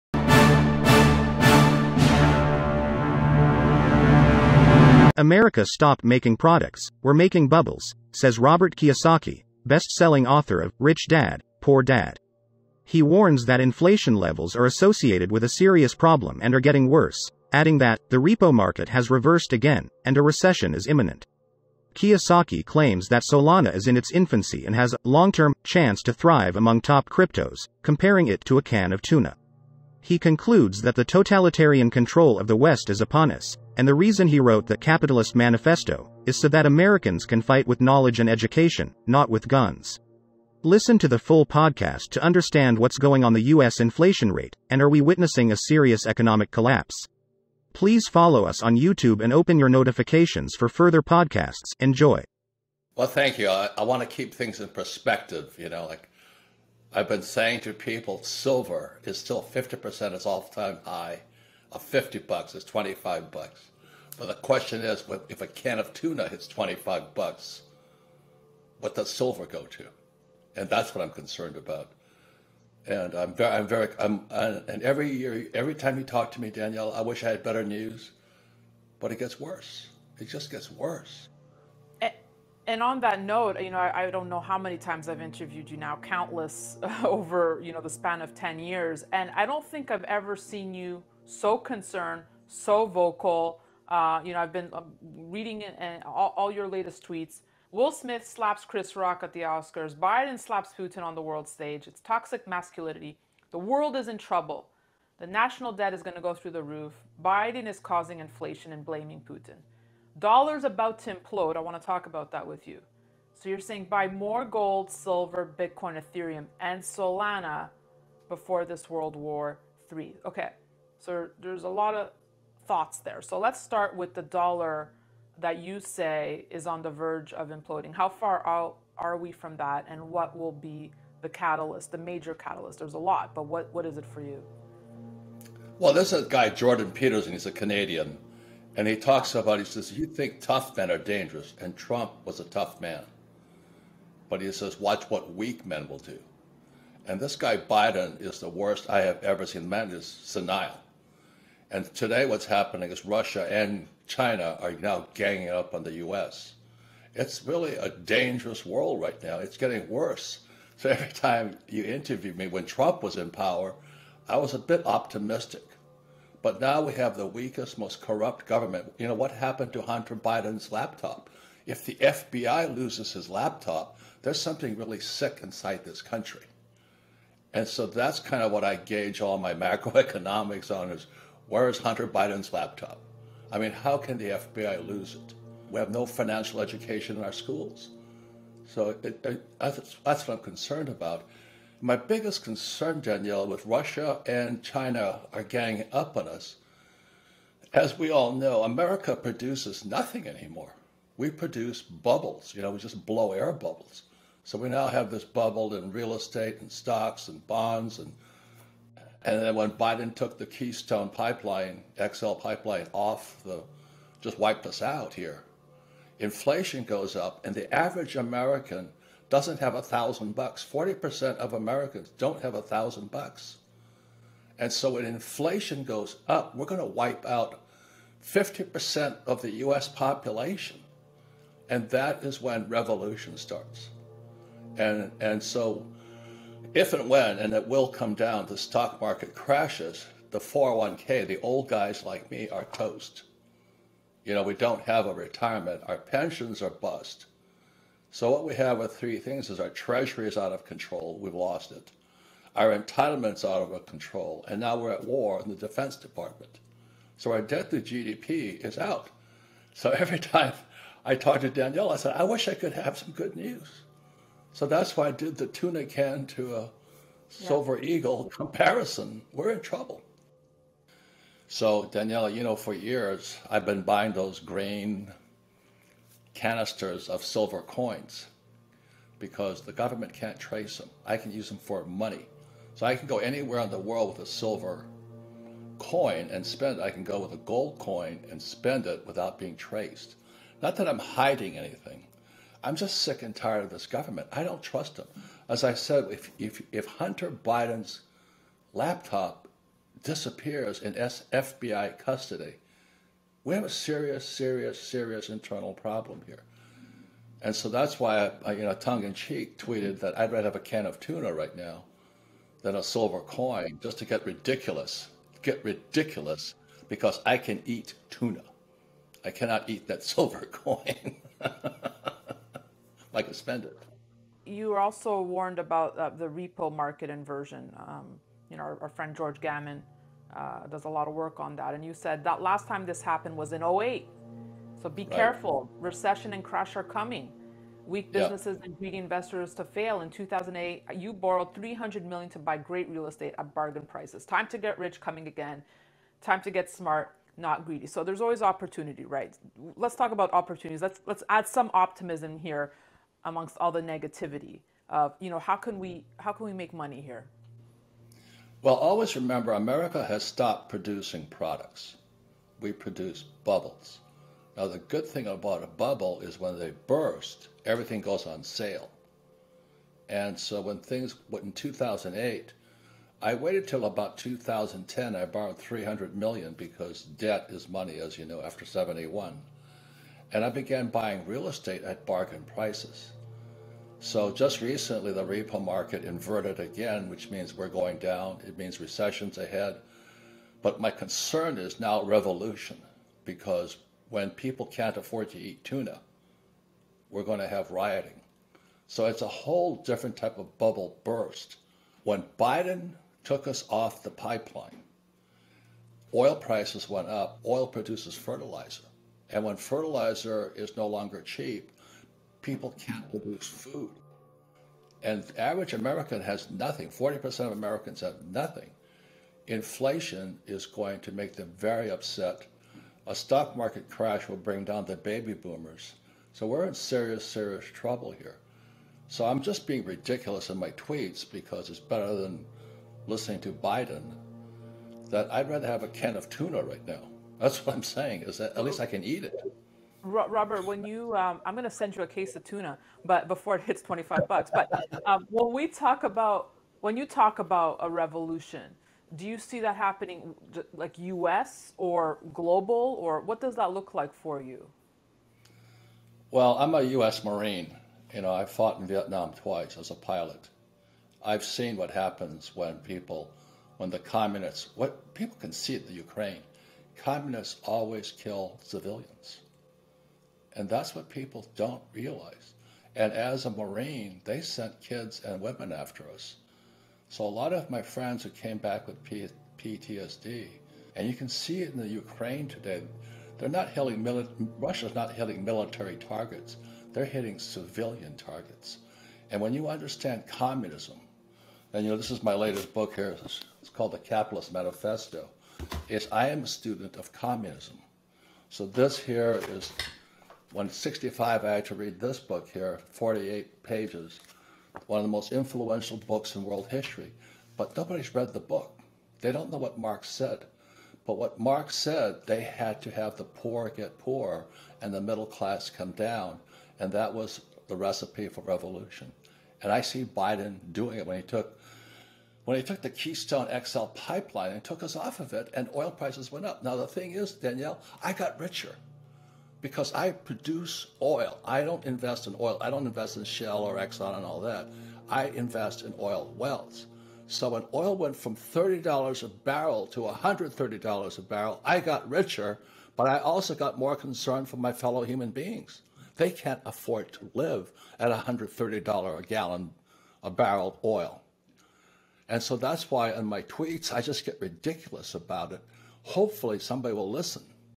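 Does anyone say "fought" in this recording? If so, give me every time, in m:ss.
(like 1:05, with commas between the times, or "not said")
7:38.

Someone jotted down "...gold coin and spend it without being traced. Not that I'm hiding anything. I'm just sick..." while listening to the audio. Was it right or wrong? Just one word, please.
right.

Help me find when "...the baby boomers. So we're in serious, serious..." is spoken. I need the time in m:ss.
7:04.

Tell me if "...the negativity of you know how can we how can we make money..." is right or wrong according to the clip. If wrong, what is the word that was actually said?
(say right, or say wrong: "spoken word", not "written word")
right.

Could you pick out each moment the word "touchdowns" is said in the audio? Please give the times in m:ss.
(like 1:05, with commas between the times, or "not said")
not said.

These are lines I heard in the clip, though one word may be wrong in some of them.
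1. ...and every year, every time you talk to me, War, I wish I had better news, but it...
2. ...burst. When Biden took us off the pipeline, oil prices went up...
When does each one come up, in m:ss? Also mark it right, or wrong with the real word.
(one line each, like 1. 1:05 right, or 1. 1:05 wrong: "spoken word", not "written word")
1. 1:14 wrong: "Danielle", not "War"
2. 6:41 right.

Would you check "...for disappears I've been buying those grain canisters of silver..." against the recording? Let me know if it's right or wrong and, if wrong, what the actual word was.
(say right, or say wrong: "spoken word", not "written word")
wrong: "years", not "disappears".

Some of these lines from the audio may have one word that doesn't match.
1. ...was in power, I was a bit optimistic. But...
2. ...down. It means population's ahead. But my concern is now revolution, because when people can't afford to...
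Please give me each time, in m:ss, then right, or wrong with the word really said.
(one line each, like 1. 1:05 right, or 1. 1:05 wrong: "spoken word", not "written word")
1. 2:43 right
2. 6:27 wrong: "recession", not "population".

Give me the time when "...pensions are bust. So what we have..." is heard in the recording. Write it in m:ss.
4:05.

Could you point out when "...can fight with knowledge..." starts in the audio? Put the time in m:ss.
0:37.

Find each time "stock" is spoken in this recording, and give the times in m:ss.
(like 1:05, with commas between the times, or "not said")
3:26, 3:58, 7:03.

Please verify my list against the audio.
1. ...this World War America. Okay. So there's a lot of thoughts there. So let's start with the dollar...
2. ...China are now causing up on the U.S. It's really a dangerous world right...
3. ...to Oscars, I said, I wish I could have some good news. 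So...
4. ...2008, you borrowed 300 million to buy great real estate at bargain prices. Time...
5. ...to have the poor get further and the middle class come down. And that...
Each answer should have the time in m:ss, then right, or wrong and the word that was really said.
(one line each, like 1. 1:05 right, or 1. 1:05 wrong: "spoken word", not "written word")
1. 1:58 wrong: "III", not "America"
2. 2:34 wrong: "ganging", not "causing"
3. 4:21 wrong: "Danielle", not "Oscars"
4. 5:40 right
5. 8:32 wrong: "poorer", not "further".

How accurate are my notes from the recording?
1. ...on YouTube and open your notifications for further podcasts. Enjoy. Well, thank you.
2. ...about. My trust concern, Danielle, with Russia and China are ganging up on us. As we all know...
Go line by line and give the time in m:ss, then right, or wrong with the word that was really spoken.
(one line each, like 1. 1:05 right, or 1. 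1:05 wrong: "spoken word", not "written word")
1. 0:48 right
2. 3:10 wrong: "biggest", not "trust".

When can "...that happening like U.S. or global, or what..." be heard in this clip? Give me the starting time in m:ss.
7:29.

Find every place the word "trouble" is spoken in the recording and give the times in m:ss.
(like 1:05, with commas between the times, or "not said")
1:44, 4:29, 7:07.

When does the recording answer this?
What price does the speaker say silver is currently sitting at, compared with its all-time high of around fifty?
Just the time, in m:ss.
1:02.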